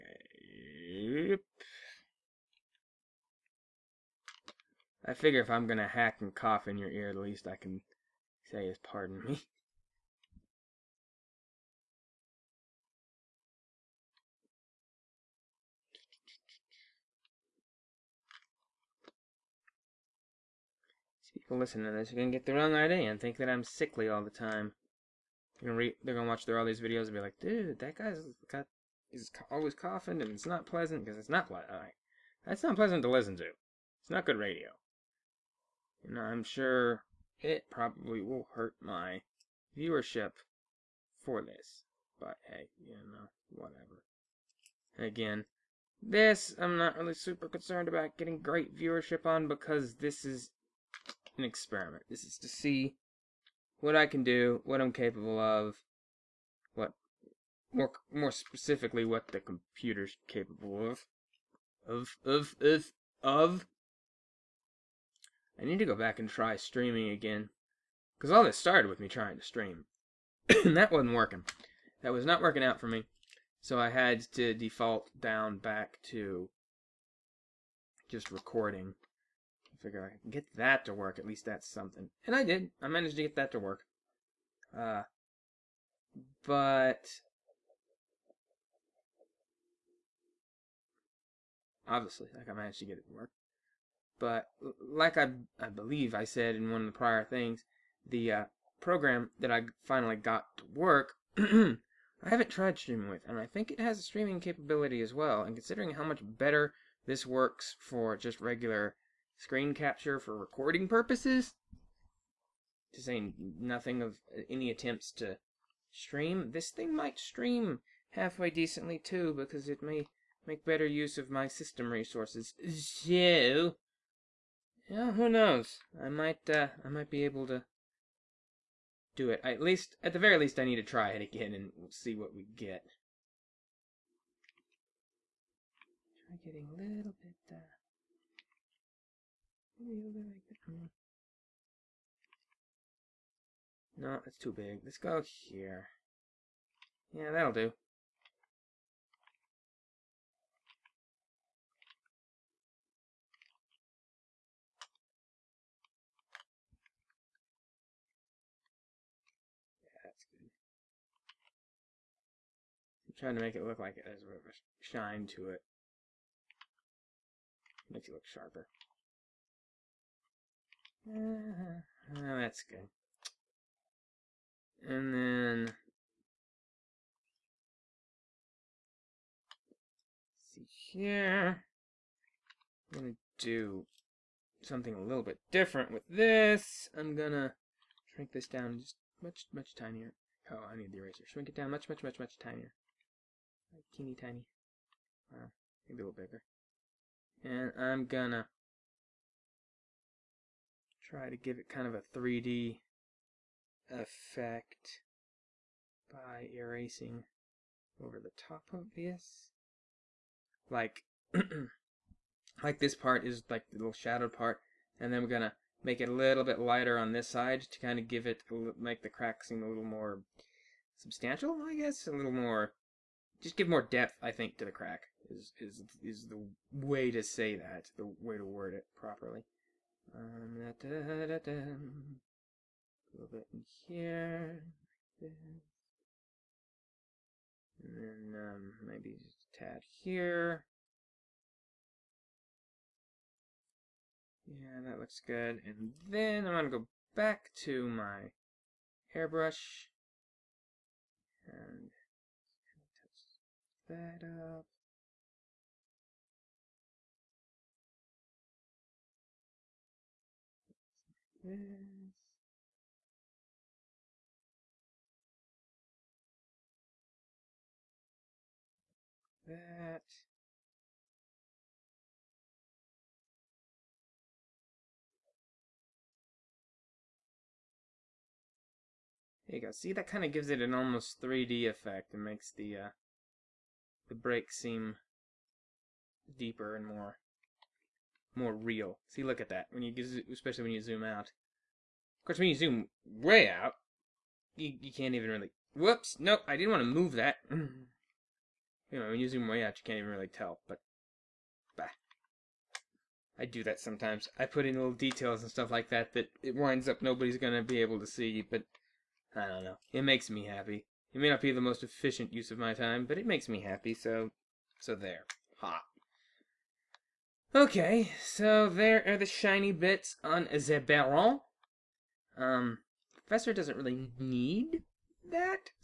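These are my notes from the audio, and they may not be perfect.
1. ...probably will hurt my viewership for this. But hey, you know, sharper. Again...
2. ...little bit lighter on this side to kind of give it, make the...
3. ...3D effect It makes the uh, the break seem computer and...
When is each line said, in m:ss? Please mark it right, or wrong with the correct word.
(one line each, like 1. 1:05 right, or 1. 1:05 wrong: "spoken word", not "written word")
1. 0:37 wrong: "whatever", not "sharper"
2. 3:36 right
3. 4:41 wrong: "deeper", not "computer".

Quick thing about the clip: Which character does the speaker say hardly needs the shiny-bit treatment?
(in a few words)
Professor.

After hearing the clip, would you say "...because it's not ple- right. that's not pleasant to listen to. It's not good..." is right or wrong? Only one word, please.
right.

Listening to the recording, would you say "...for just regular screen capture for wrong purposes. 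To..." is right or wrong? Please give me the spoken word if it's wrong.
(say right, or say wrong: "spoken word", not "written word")
wrong: "recording", not "wrong".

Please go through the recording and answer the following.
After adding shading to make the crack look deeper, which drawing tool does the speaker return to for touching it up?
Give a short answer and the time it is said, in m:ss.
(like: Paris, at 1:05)
Airbrush, at 4:09.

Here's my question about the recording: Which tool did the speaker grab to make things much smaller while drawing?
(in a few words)
The eraser.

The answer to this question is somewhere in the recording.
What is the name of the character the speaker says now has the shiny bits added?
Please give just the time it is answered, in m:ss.
5:20.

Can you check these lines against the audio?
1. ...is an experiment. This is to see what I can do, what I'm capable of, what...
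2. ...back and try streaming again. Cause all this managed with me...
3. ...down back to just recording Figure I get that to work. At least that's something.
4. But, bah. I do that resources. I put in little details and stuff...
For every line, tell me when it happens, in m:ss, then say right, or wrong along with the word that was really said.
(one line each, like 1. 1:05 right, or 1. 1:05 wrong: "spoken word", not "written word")
1. 0:50 right
2. 1:05 wrong: "started", not "managed"
3. 1:15 right
4. 5:00 wrong: "sometimes", not "resources".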